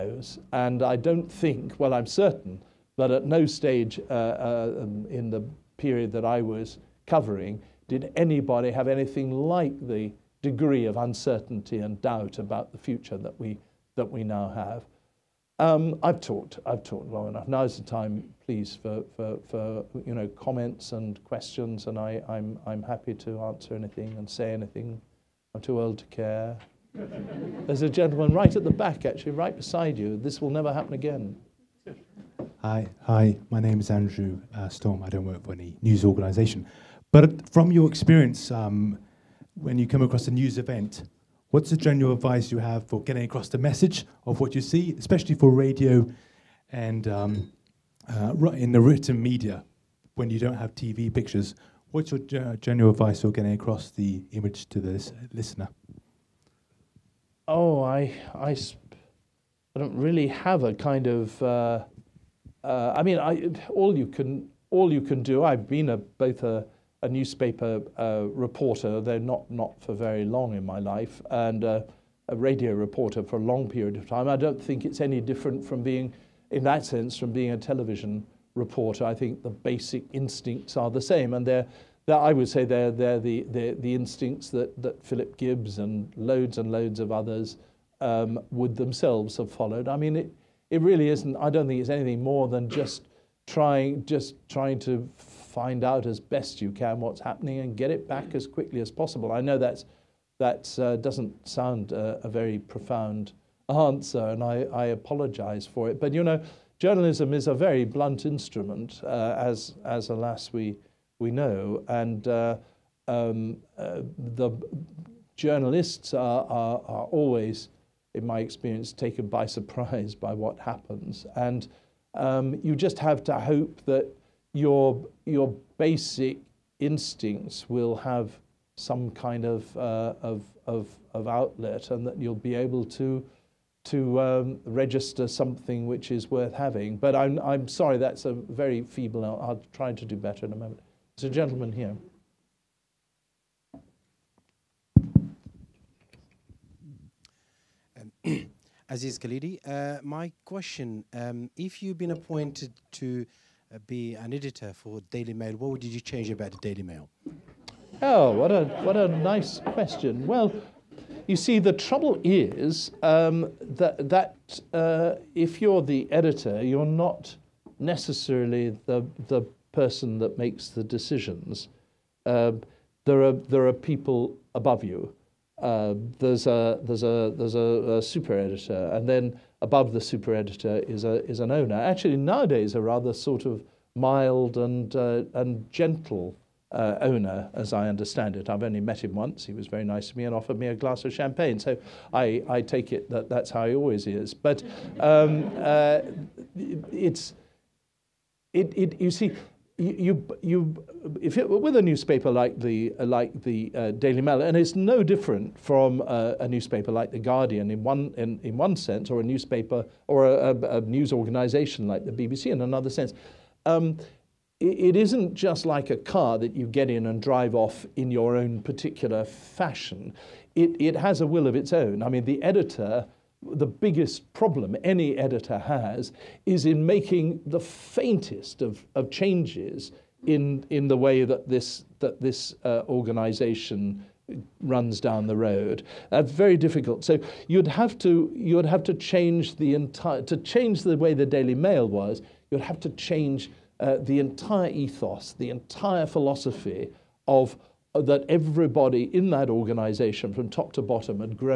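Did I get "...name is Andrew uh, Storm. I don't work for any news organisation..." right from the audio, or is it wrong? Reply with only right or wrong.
right.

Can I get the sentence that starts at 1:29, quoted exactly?
I mean, it, it really isn't.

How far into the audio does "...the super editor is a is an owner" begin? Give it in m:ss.
2:59.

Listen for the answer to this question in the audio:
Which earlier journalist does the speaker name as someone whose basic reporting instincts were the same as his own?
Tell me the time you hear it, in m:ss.
1:25.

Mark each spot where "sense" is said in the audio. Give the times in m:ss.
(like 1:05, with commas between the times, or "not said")
1:16, 3:28, 3:32.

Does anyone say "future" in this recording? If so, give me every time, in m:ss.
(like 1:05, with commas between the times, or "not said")
0:12.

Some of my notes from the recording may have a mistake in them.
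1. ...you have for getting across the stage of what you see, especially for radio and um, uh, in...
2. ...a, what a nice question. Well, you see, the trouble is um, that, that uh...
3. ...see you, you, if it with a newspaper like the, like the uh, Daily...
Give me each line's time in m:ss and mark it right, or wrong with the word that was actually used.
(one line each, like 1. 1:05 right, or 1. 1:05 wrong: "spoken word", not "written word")
1. 0:42 wrong: "message", not "stage"
2. 2:38 right
3. 3:19 right.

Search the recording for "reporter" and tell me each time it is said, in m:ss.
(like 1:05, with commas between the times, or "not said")
1:08, 1:12, 1:18.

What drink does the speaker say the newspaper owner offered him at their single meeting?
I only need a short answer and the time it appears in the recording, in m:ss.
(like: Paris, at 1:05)
champagne, at 3:11.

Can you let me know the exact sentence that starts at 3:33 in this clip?
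Um, it, it isn't just like a car that you get in and drive off in your own particular fashion.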